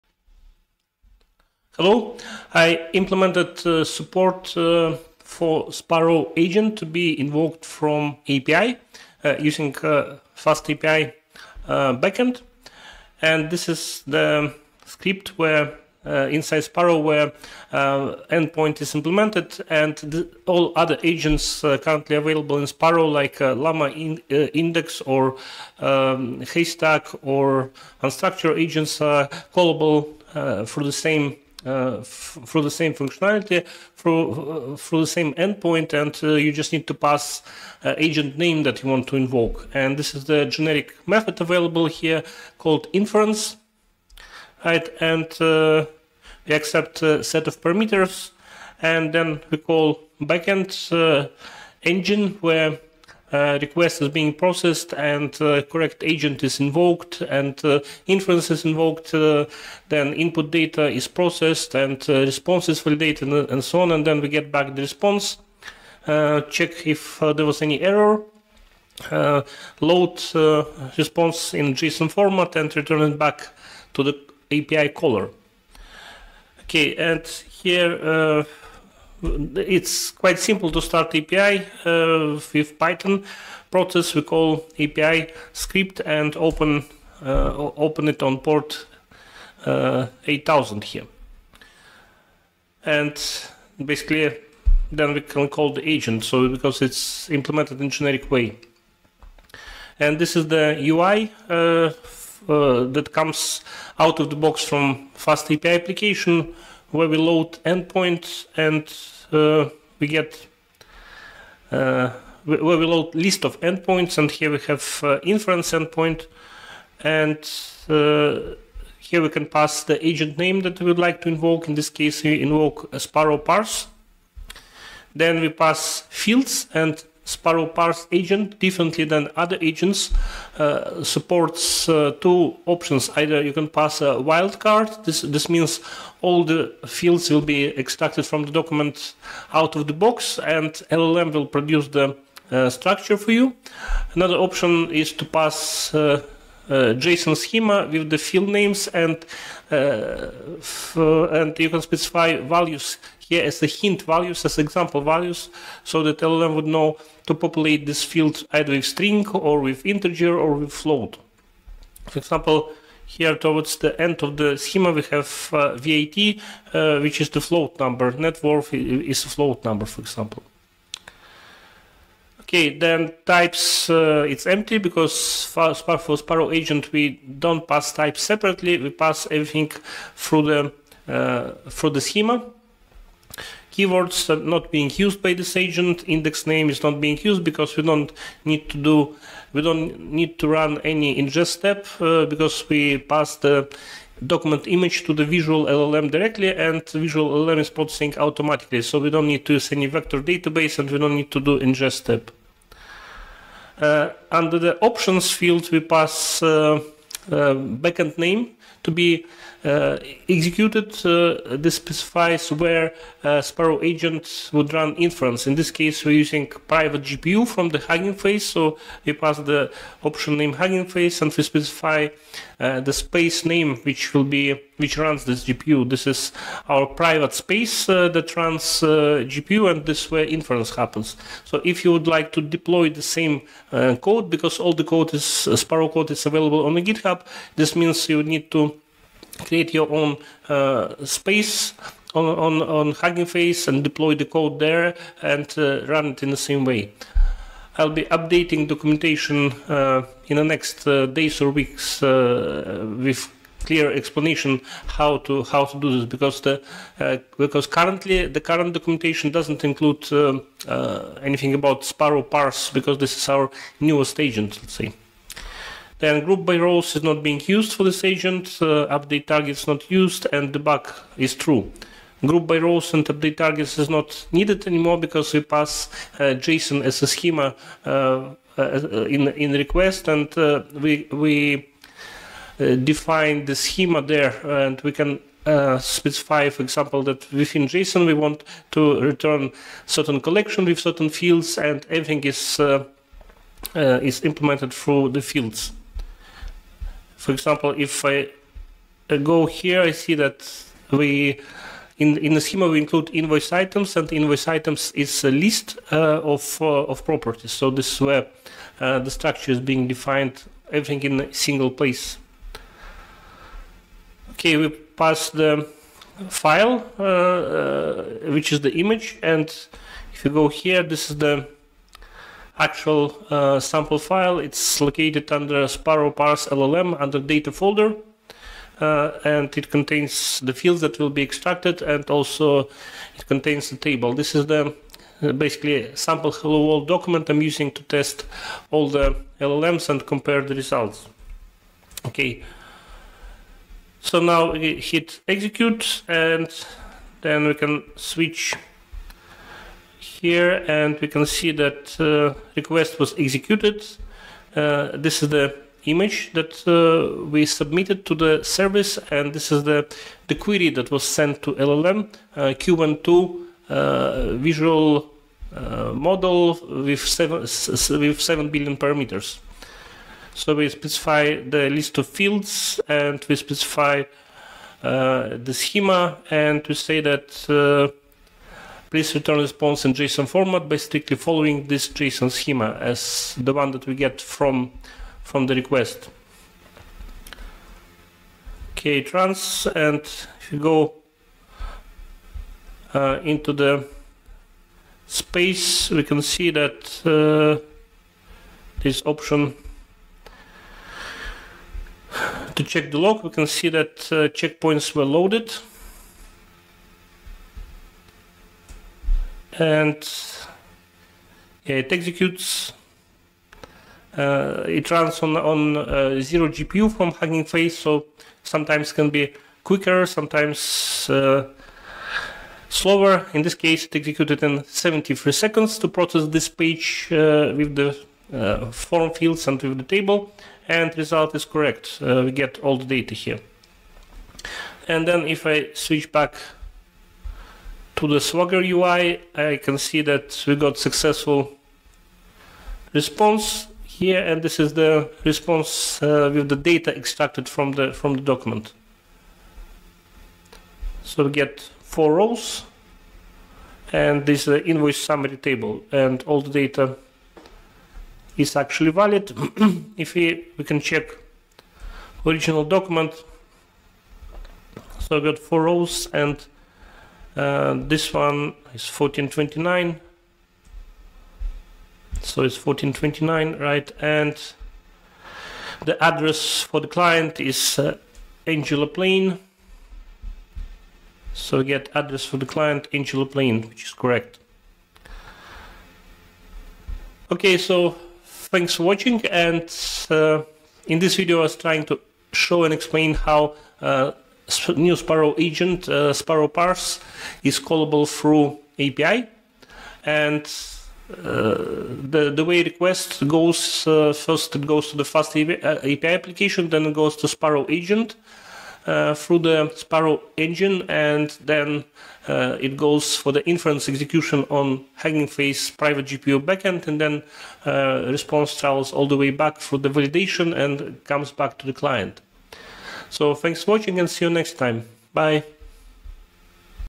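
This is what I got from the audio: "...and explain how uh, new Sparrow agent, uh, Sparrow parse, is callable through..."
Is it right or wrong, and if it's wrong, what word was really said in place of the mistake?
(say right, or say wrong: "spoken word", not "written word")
right.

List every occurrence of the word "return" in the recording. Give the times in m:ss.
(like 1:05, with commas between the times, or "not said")
1:12, 4:49, 6:19.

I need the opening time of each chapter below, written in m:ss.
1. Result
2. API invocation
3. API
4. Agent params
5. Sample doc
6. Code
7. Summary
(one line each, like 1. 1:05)
1. 7:04
2. 5:48
3. 1:21
4. 2:00
5. 5:22
6. 0:42
7. 8:08.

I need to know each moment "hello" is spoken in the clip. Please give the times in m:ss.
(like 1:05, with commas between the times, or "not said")
0:01, 5:36.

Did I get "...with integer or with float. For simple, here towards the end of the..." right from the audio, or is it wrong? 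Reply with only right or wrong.
wrong.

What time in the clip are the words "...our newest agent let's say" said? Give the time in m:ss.
4:23.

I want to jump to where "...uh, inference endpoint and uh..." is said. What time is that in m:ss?
1:55.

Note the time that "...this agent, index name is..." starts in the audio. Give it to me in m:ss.
3:05.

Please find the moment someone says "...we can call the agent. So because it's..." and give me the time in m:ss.
1:35.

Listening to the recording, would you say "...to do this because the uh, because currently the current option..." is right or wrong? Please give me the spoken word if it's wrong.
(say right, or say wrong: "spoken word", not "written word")
wrong: "documentation", not "option".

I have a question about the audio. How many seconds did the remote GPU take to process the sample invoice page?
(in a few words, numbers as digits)
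73.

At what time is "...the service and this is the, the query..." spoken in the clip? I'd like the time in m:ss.
5:58.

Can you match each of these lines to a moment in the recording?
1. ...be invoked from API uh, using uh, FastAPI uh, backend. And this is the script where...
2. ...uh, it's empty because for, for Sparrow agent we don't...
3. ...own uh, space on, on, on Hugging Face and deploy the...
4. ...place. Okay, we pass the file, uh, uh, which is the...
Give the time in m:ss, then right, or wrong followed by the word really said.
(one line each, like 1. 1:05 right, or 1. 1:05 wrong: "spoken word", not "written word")
1. 0:06 right
2. 2:53 right
3. 3:59 right
4. 5:11 right.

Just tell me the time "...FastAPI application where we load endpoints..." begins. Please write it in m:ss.
1:45.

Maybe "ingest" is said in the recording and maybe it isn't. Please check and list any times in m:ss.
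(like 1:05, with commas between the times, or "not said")
3:11, 3:21.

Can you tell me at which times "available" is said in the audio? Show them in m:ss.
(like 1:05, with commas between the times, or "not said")
0:22, 0:41, 3:56.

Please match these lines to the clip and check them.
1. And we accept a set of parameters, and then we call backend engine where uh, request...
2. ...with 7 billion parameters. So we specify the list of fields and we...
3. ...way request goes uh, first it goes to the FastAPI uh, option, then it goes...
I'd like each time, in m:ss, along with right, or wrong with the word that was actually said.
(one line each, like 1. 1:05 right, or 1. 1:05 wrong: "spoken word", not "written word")
1. 0:44 right
2. 6:07 right
3. 8:22 wrong: "application", not "option".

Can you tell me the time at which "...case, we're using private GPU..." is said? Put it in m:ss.
3:35.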